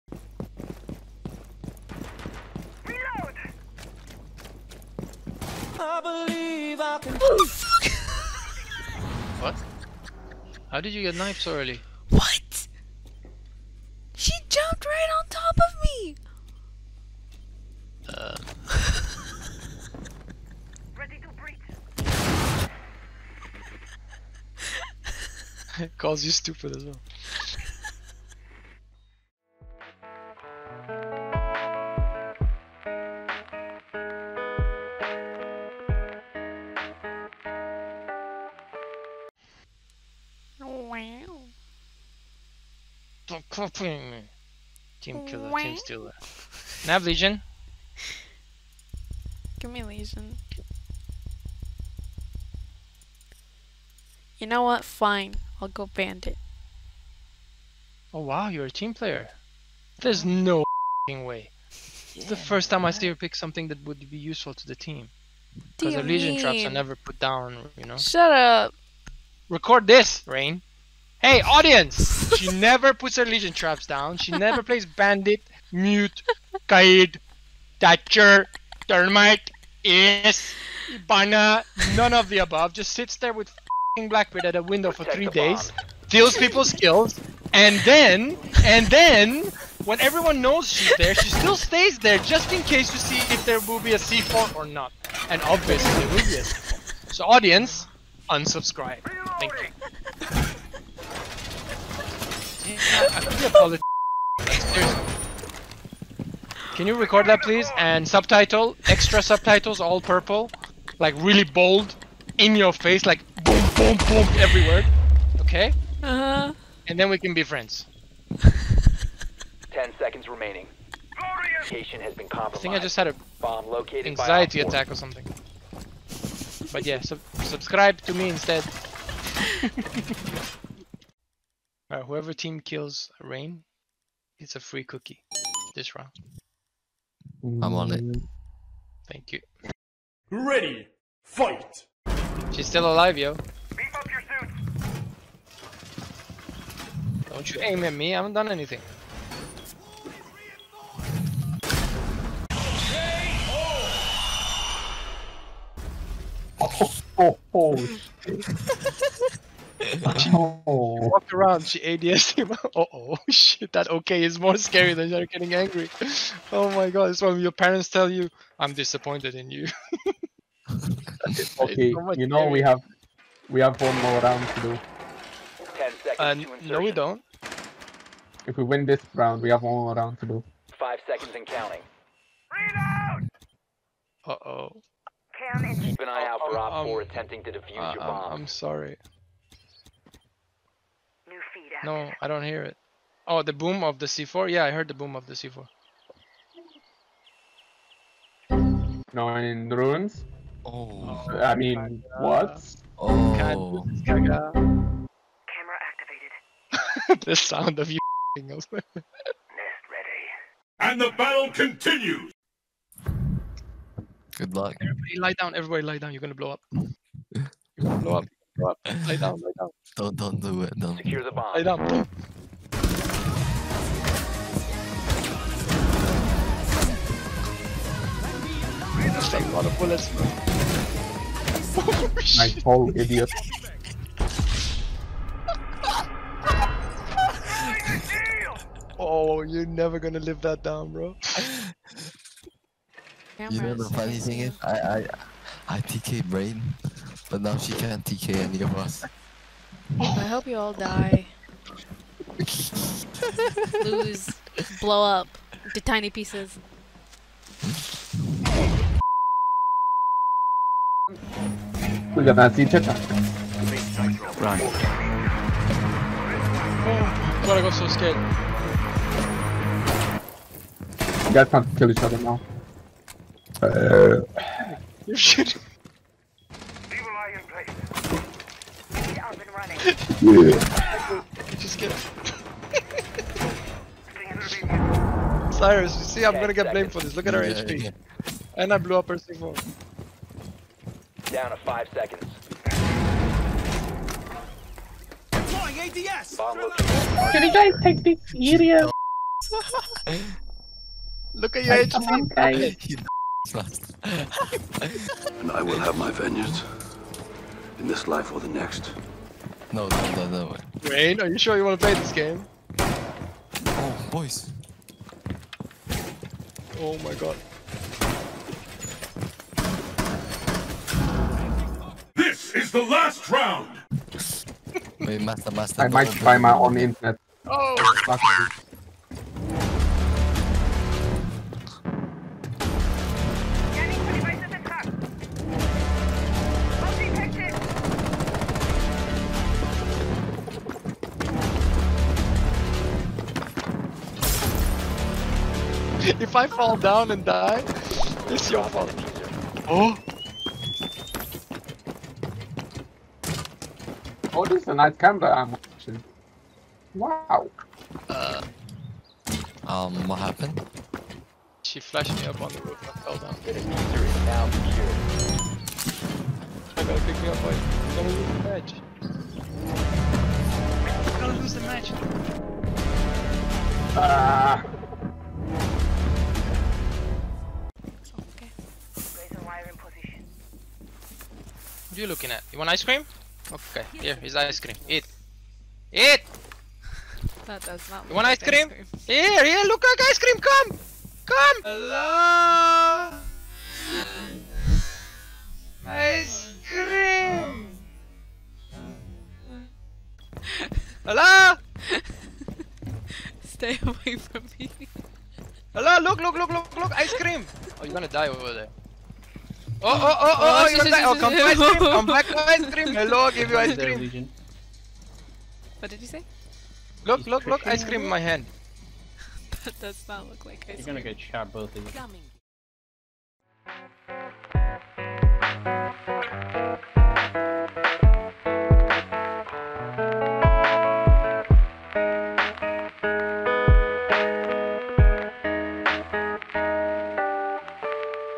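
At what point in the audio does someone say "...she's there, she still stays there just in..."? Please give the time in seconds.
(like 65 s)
90 s.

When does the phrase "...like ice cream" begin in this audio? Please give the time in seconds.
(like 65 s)
420 s.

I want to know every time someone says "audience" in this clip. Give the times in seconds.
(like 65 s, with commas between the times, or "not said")
71 s, 97 s.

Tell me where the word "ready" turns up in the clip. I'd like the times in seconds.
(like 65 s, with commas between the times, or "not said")
20 s, 140 s, 208 s.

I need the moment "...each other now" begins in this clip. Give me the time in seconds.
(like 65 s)
271 s.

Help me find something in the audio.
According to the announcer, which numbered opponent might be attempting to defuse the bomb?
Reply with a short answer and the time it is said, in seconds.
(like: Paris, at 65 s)
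Op 4, at 186 s.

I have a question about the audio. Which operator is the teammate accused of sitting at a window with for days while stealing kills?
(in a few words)
Blackbeard.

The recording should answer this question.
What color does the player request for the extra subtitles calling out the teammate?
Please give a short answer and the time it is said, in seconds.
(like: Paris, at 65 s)
Purple, at 109 s.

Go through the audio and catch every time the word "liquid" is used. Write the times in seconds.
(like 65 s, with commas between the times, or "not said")
not said.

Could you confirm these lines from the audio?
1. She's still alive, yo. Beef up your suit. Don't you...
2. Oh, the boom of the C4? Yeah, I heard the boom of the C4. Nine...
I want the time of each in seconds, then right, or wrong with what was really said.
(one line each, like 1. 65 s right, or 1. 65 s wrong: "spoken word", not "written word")
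1. 142 s right
2. 193 s right.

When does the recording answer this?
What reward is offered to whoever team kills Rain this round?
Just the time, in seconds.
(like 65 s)
134 s.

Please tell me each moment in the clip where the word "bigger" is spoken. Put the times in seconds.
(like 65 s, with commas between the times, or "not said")
not said.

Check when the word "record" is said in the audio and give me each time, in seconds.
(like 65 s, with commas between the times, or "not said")
69 s, 106 s.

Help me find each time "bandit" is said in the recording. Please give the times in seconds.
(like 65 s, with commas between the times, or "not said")
55 s, 74 s.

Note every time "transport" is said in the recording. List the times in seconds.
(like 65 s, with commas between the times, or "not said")
not said.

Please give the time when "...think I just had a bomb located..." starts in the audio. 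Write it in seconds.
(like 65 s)
122 s.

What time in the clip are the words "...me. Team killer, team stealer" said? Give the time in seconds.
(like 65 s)
44 s.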